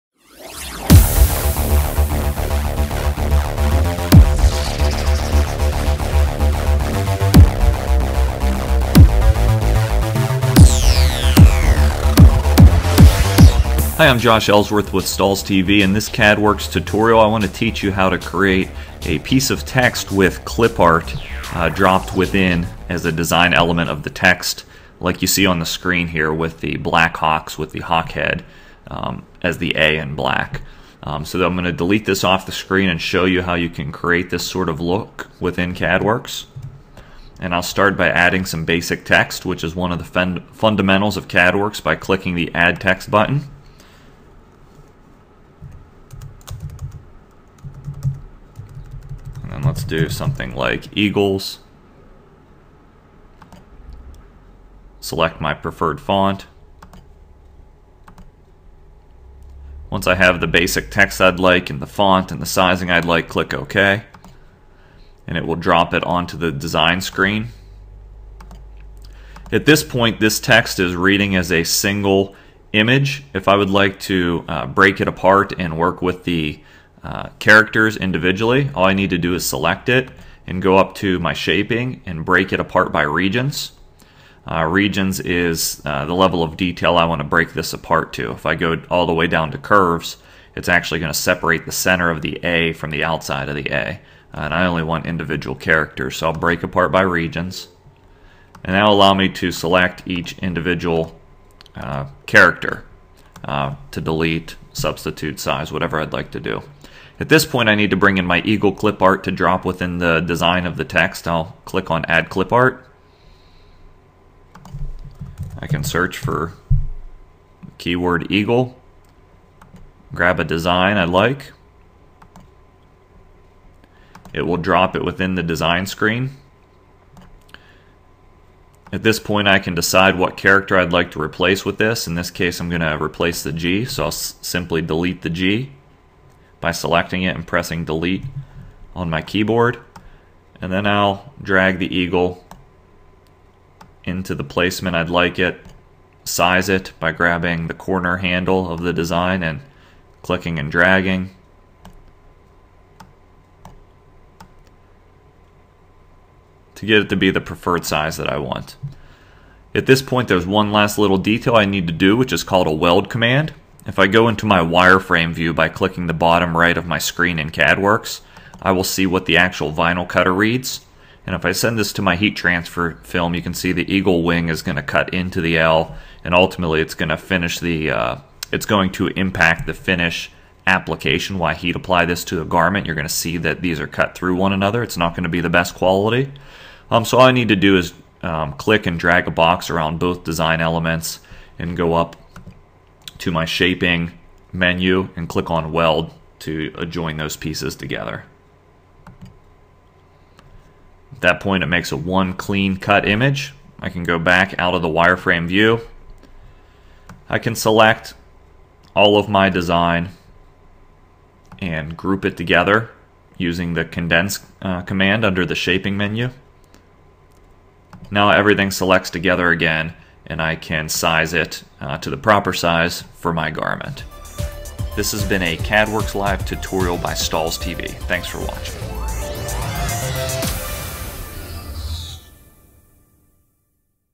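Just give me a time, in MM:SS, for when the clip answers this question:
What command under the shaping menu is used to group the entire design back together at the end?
03:33.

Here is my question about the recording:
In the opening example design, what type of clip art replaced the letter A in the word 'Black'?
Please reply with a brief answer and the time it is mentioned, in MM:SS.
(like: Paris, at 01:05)
Hawk head, at 00:27.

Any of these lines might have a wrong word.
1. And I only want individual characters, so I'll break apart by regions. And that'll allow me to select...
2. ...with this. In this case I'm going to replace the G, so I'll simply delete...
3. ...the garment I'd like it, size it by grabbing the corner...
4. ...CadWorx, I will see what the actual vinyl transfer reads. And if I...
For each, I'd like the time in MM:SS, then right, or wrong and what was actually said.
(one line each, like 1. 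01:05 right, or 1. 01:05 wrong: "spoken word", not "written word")
1. 01:34 right
2. 02:11 right
3. 02:24 wrong: "placement", not "garment"
4. 02:47 wrong: "cutter", not "transfer".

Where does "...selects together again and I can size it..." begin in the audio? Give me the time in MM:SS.
03:38.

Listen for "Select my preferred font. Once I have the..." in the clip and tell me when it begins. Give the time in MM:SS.
00:54.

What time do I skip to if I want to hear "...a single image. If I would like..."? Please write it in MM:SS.
01:11.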